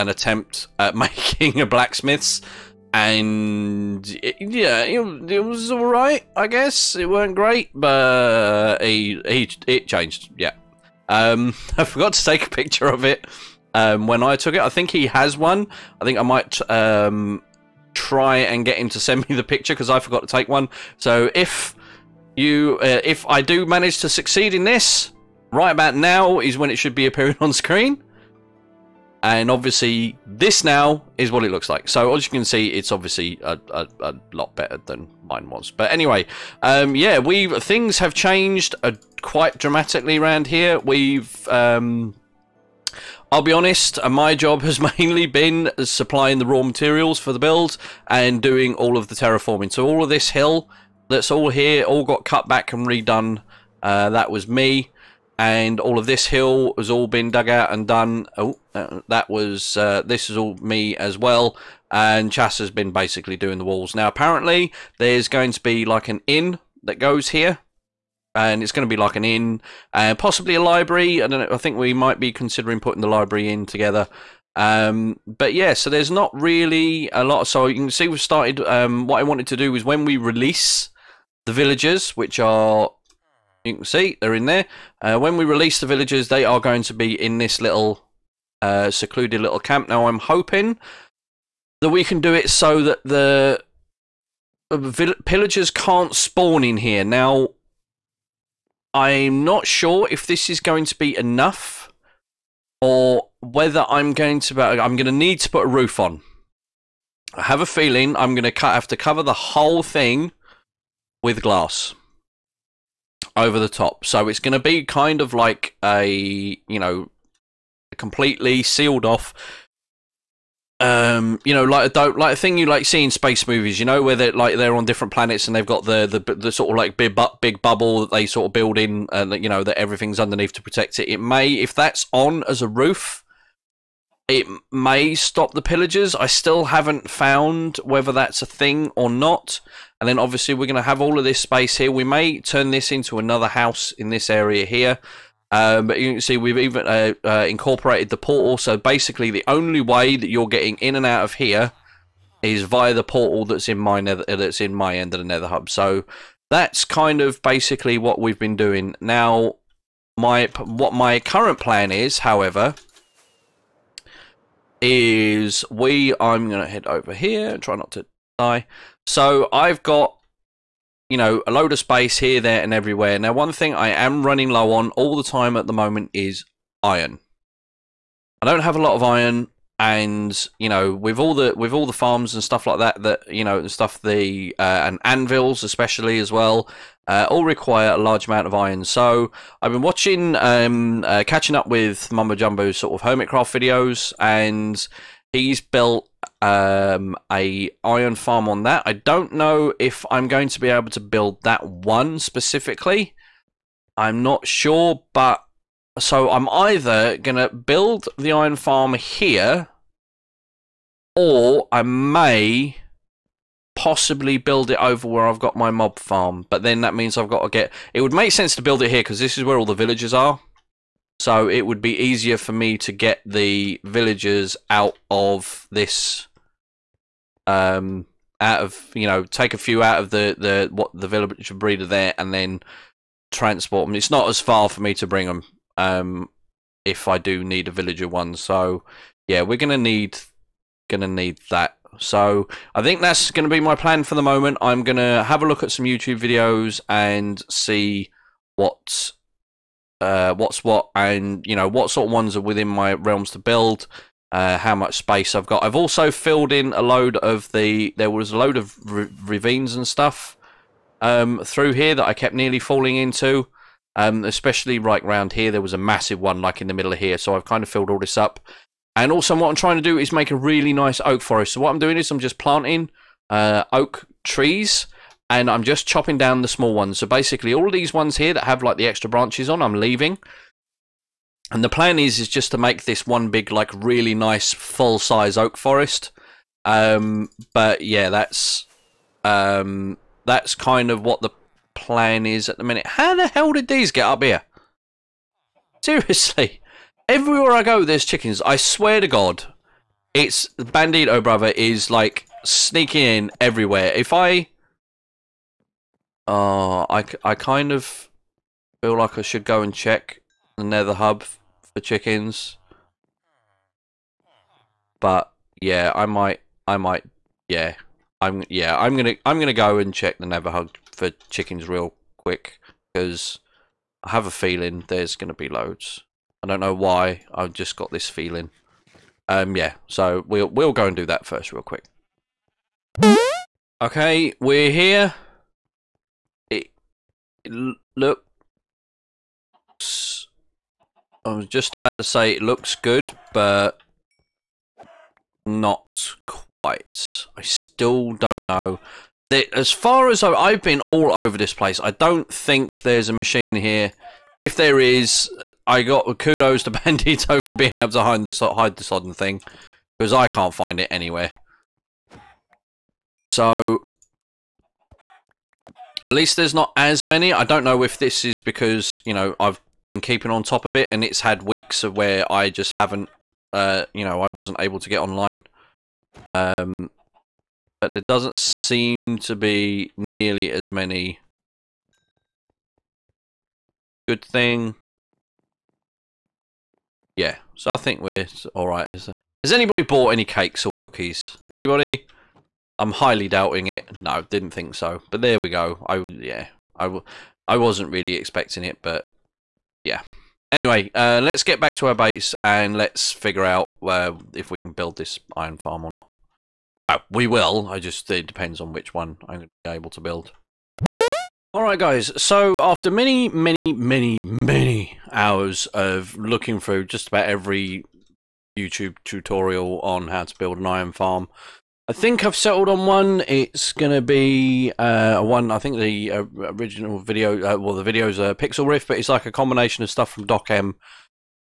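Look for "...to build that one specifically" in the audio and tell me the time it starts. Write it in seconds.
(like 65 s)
200 s.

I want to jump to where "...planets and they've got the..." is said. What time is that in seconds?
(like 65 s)
125 s.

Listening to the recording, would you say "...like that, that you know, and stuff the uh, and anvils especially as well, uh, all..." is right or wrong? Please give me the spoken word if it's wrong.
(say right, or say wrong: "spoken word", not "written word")
right.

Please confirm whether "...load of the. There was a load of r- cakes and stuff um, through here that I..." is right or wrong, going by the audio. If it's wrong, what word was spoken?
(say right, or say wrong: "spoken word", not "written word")
wrong: "ravines", not "cakes".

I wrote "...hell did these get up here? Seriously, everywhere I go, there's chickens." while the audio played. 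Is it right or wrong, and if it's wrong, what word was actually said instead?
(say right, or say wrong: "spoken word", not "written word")
right.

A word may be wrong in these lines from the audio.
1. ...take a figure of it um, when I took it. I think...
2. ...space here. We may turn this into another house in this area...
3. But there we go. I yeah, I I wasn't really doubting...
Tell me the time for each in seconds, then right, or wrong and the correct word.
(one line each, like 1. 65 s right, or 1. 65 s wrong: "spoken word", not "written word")
1. 12 s wrong: "picture", not "figure"
2. 141 s right
3. 395 s wrong: "expecting", not "doubting".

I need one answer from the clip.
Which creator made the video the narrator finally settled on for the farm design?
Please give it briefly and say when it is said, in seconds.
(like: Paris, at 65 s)
Pixlriffs, at 428 s.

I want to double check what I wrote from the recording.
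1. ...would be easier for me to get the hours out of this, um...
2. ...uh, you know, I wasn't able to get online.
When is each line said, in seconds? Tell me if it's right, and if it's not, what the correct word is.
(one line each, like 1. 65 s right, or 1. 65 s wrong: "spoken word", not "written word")
1. 221 s wrong: "villagers", not "hours"
2. 373 s right.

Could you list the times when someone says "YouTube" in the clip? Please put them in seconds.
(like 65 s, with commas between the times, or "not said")
245 s, 418 s.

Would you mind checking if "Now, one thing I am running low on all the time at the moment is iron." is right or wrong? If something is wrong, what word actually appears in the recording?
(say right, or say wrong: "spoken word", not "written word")
right.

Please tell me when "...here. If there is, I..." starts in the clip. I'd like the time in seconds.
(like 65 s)
353 s.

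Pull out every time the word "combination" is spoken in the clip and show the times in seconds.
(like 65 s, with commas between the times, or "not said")
429 s.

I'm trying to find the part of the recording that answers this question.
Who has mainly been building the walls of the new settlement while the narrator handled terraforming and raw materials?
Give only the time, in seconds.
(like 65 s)
62 s.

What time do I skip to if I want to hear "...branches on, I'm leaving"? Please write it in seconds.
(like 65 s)
279 s.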